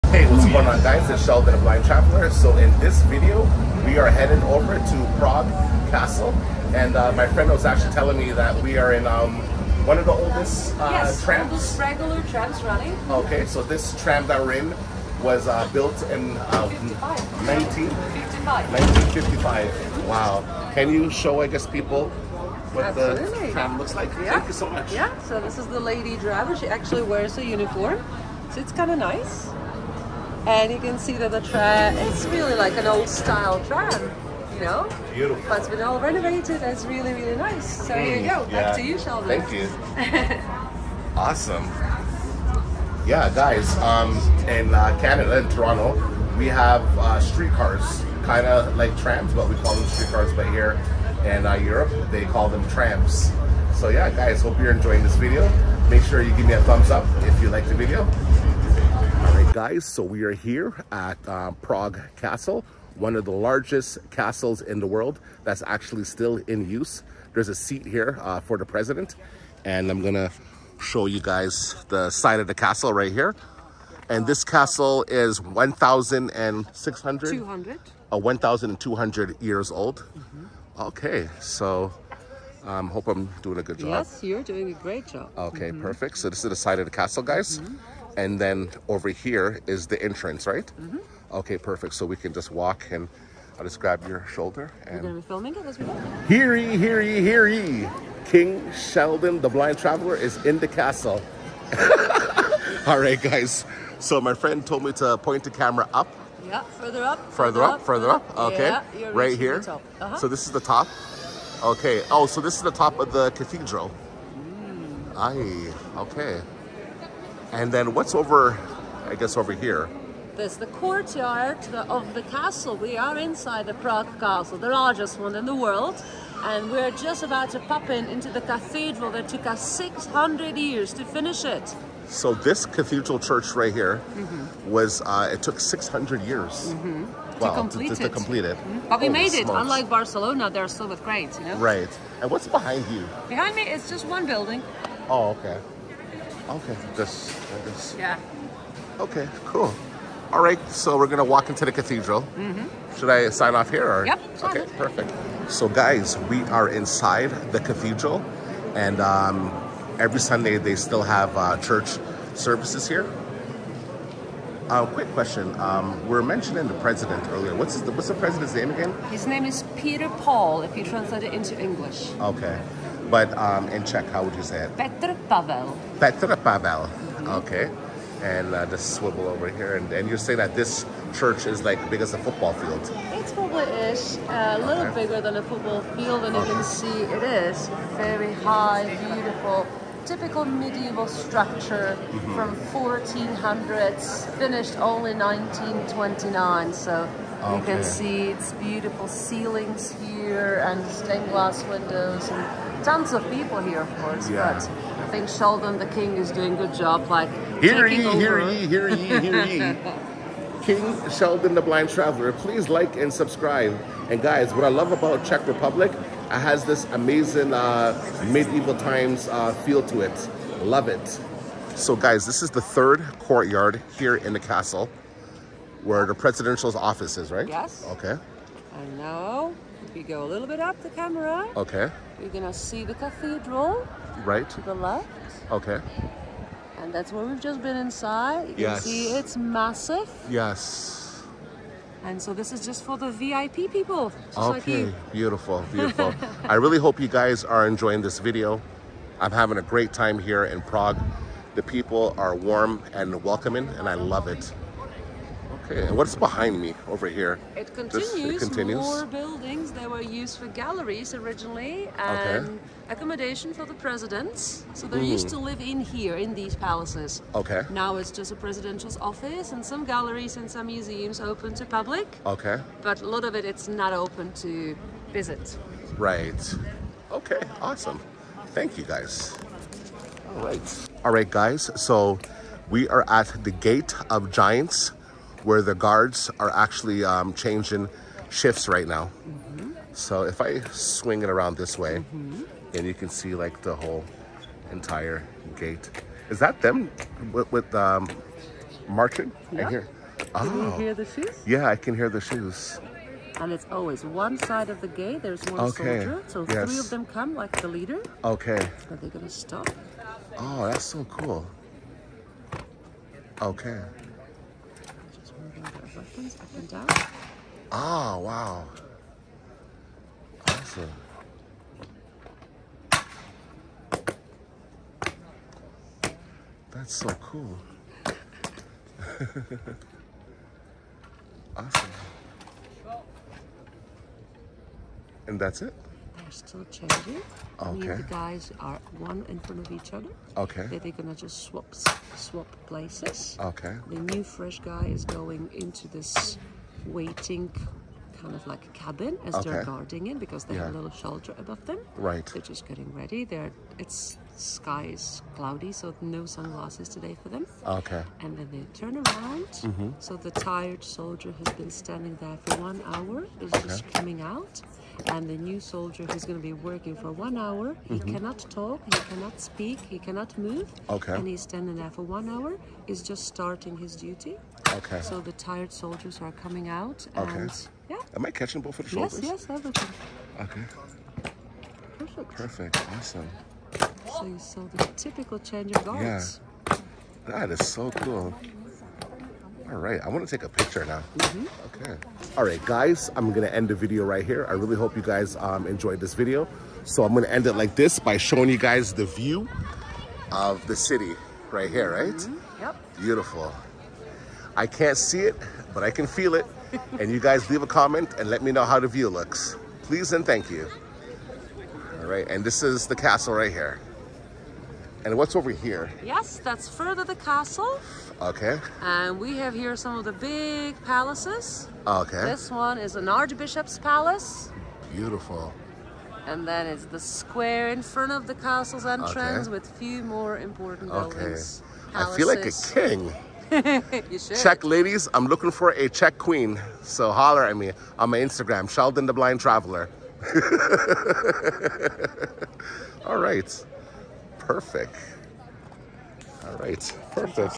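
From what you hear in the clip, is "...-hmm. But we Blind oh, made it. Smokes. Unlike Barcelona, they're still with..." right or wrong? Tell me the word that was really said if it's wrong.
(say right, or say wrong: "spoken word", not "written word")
wrong: "Holy", not "Blind".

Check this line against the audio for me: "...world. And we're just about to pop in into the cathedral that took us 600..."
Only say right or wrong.
right.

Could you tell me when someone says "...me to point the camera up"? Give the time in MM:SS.
01:44.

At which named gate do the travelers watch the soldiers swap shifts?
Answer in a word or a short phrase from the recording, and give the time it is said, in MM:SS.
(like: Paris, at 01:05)
Gate of Giants, at 04:43.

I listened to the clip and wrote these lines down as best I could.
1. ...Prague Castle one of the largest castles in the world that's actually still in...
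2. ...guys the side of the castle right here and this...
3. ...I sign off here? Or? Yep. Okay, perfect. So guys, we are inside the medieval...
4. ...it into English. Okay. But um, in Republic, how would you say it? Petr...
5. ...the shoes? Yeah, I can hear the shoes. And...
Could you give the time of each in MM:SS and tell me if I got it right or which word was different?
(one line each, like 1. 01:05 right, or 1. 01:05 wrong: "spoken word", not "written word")
1. 01:01 right
2. 01:11 right
3. 02:33 wrong: "cathedral", not "medieval"
4. 02:51 wrong: "Czech", not "Republic"
5. 05:00 right.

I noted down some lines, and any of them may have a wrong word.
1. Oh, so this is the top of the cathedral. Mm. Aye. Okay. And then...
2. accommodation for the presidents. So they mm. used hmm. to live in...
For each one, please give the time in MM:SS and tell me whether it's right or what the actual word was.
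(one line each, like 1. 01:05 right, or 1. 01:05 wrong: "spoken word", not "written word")
1. 01:52 right
2. 04:22 right.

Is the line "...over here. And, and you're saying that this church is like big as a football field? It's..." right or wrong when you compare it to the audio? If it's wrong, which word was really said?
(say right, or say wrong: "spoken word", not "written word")
right.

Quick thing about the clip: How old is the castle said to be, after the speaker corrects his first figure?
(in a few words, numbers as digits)
1,200 years.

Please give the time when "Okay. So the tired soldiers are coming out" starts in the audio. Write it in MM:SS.
06:14.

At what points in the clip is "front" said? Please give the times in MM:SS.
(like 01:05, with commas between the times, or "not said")
05:39, 07:07.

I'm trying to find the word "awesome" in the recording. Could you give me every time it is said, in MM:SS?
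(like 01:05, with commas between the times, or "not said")
00:41, 04:37, 05:20, 05:31, 06:22.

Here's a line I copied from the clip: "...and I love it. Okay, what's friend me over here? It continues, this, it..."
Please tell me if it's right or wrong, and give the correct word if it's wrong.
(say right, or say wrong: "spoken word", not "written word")
wrong: "behind", not "friend".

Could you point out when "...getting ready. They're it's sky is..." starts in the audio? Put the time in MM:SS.
05:52.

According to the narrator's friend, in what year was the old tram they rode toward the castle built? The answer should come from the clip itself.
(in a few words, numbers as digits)
1955.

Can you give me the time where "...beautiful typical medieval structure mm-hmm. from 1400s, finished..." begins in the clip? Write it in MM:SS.
03:09.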